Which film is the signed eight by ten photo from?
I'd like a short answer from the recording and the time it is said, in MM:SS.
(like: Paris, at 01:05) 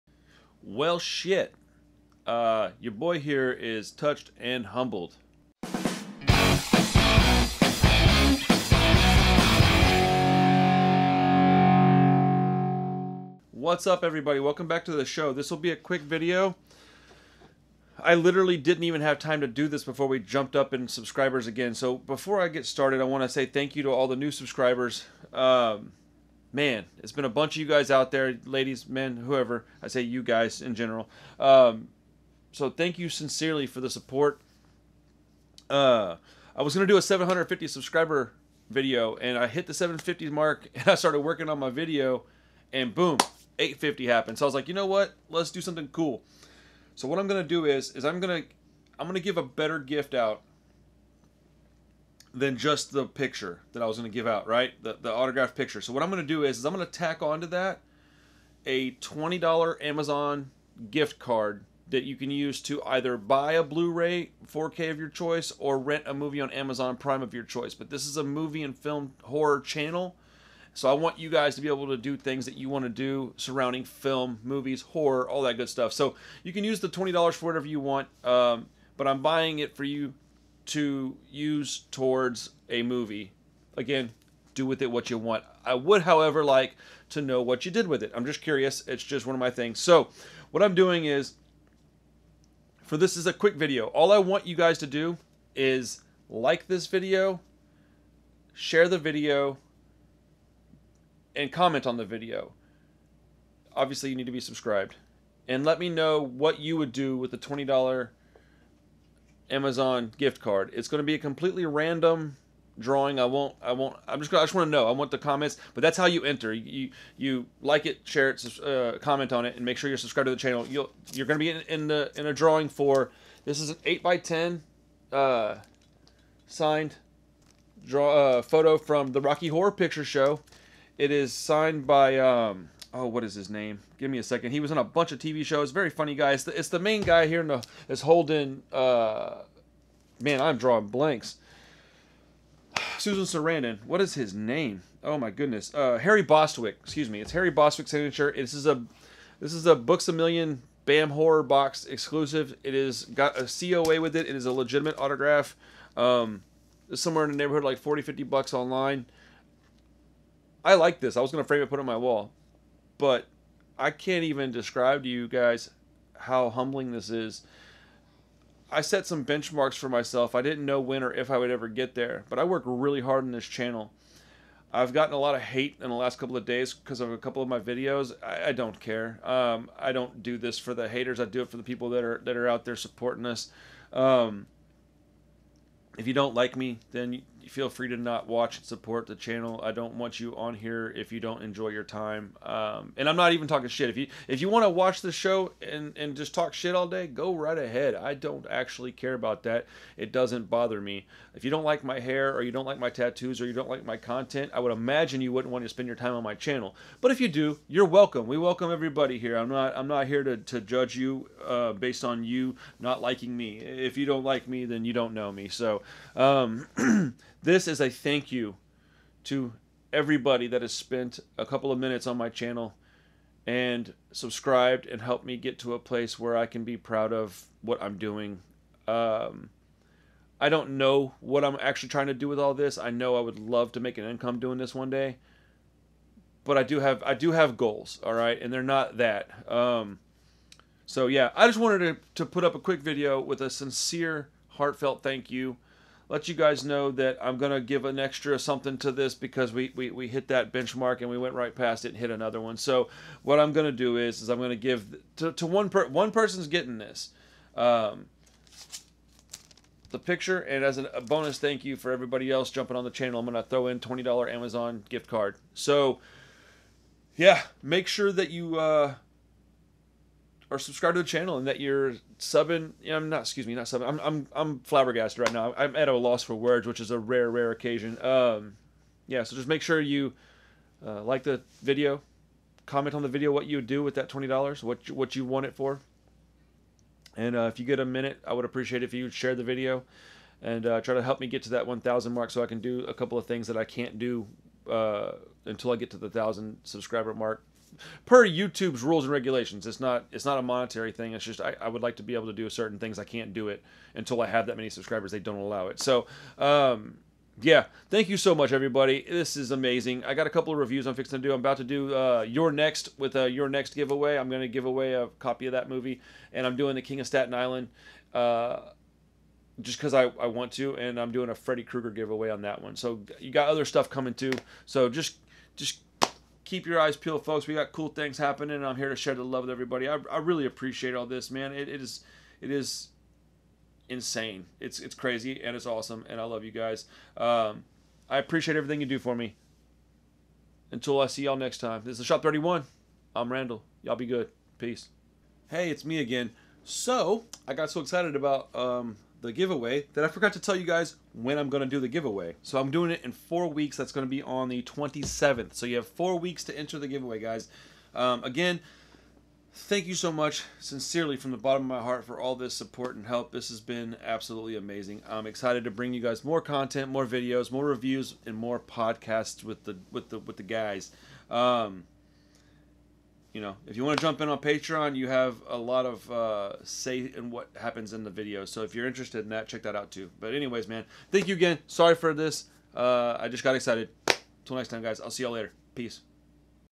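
The Rocky Horror Picture Show, at 02:09.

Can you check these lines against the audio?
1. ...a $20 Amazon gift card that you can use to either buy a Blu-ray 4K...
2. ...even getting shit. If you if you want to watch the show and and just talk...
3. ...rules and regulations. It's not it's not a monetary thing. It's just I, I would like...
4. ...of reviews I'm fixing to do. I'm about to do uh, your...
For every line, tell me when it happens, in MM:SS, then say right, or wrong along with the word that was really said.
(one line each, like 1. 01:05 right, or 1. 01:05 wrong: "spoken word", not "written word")
1. 00:58 right
2. 03:13 wrong: "talking", not "getting"
3. 04:58 right
4. 05:10 right.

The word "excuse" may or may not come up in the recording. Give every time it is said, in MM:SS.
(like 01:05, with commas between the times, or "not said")
02:26, 04:33.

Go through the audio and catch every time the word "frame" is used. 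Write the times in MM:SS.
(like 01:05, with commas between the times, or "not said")
02:41.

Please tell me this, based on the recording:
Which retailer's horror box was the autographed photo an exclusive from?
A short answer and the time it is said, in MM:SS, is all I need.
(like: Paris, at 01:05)
Books a Million, at 02:29.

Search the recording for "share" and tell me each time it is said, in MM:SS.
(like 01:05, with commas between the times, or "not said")
01:38, 01:58, 04:49, 05:28.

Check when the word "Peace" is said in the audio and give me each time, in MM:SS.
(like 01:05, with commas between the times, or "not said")
05:44, 06:25.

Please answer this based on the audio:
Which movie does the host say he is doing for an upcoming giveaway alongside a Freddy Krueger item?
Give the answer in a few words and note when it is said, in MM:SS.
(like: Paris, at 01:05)
The King of Staten Island, at 05:16.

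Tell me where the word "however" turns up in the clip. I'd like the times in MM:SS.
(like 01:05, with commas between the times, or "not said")
01:26.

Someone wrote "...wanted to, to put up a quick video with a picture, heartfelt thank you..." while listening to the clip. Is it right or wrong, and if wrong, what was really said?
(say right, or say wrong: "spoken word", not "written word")
wrong: "sincere", not "picture".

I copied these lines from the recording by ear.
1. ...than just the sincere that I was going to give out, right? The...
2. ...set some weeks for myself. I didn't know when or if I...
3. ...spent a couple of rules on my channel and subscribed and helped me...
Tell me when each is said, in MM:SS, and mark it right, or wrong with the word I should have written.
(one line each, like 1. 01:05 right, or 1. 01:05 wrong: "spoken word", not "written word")
1. 00:52 wrong: "picture", not "sincere"
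2. 02:48 wrong: "benchmarks", not "weeks"
3. 03:40 wrong: "minutes", not "rules".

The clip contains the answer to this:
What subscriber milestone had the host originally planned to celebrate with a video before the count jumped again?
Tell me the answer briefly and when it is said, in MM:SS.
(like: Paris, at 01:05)
750, at 00:37.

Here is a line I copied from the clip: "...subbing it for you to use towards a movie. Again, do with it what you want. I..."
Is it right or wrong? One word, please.
wrong.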